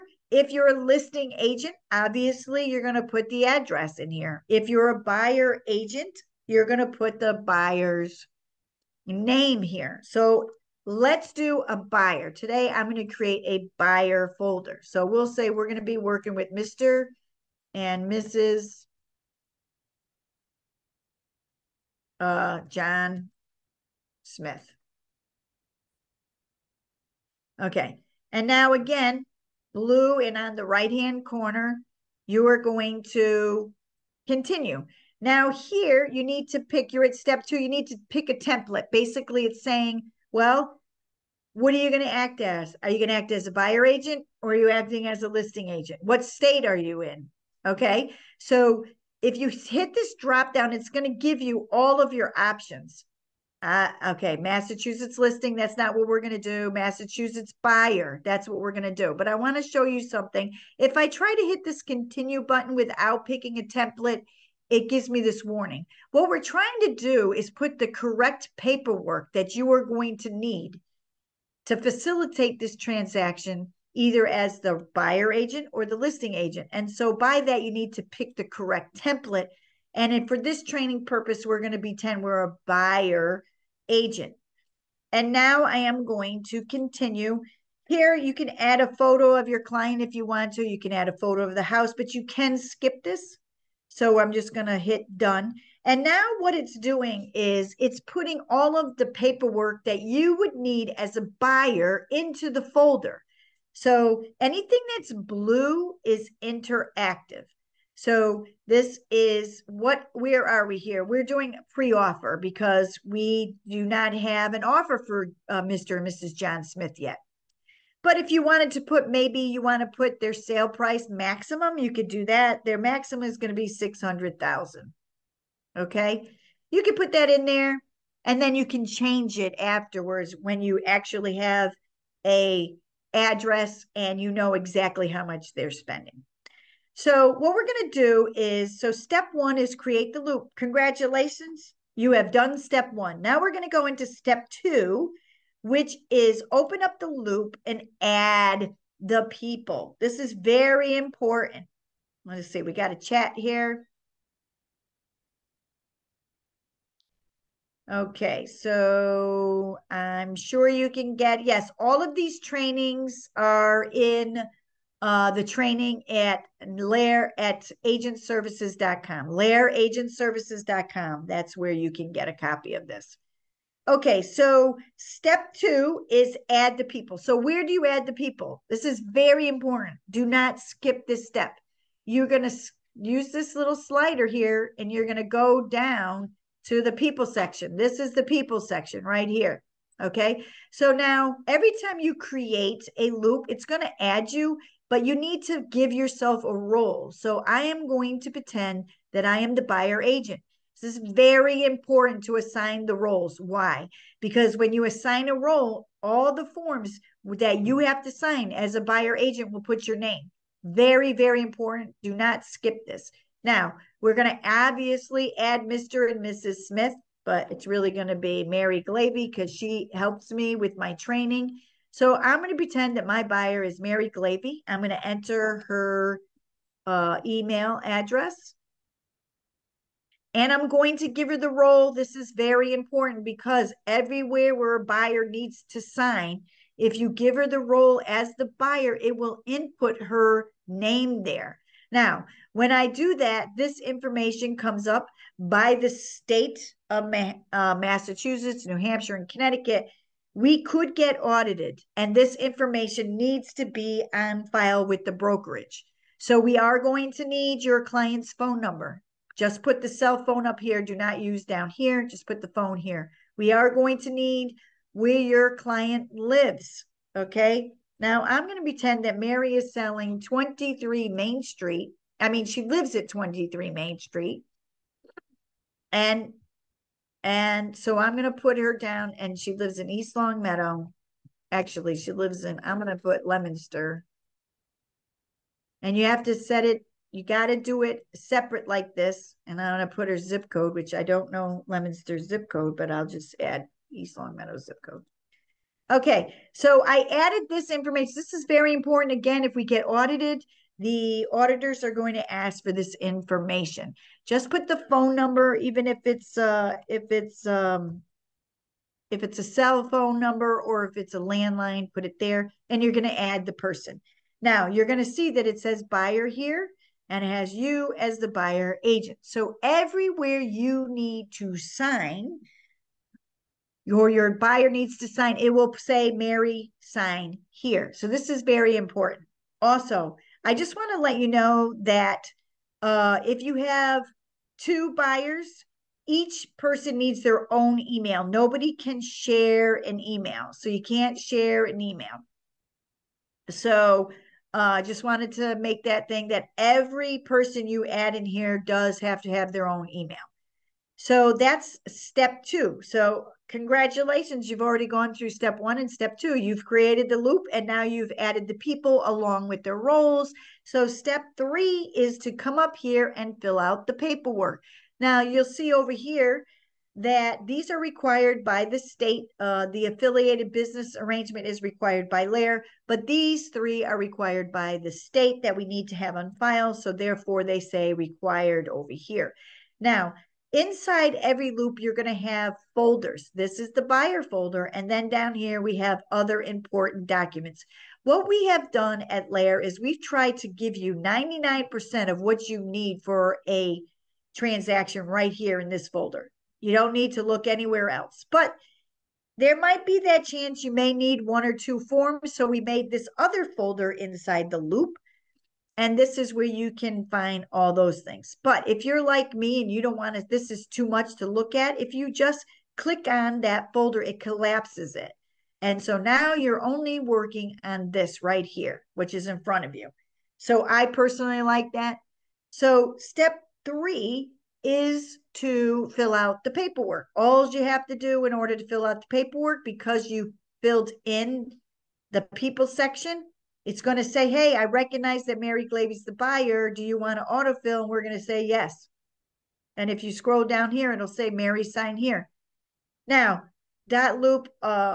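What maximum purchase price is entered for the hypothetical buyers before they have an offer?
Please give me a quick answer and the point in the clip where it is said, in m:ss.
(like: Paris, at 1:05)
600,000, at 2:03.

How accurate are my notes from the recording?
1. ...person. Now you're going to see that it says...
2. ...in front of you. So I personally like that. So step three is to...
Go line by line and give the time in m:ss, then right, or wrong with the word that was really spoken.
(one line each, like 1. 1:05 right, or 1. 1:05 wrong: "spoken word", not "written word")
1. 5:13 right
2. 6:59 right.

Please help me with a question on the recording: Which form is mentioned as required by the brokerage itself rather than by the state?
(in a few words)
affiliated business arrangement.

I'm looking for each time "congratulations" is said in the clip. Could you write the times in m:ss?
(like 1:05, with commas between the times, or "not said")
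2:20, 5:53.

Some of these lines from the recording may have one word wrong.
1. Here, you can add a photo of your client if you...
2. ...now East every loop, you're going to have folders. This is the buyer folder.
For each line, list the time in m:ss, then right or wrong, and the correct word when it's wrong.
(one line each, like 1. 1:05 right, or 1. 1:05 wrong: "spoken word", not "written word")
1. 1:27 right
2. 6:19 wrong: "Inside", not "East".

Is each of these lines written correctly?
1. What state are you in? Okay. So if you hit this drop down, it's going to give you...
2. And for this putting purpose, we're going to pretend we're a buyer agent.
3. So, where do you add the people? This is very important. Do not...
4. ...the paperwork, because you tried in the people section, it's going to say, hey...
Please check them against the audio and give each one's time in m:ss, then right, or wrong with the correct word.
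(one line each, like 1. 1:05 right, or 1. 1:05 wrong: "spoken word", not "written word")
1. 0:46 right
2. 1:19 wrong: "training", not "putting"
3. 2:57 right
4. 7:08 wrong: "filled", not "tried".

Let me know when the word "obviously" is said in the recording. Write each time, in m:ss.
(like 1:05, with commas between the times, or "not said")
0:01, 3:34.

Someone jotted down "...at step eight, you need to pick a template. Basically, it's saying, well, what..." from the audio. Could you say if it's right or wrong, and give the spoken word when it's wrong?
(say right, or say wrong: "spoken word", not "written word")
wrong: "two", not "eight".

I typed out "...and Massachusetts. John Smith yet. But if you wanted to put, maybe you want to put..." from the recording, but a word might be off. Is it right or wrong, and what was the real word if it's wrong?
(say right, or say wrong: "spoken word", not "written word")
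wrong: "Mrs", not "Massachusetts".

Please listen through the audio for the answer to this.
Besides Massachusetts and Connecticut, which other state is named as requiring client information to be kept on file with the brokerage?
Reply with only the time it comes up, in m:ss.
4:08.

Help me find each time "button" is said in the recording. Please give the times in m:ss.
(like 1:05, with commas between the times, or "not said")
1:02.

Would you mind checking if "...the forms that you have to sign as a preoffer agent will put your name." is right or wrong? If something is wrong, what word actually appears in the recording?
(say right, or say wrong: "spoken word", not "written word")
wrong: "buyer", not "preoffer".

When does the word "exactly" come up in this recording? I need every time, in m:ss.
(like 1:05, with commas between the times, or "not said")
2:14.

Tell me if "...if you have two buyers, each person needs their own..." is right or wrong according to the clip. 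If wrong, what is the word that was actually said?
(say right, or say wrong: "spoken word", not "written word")
right.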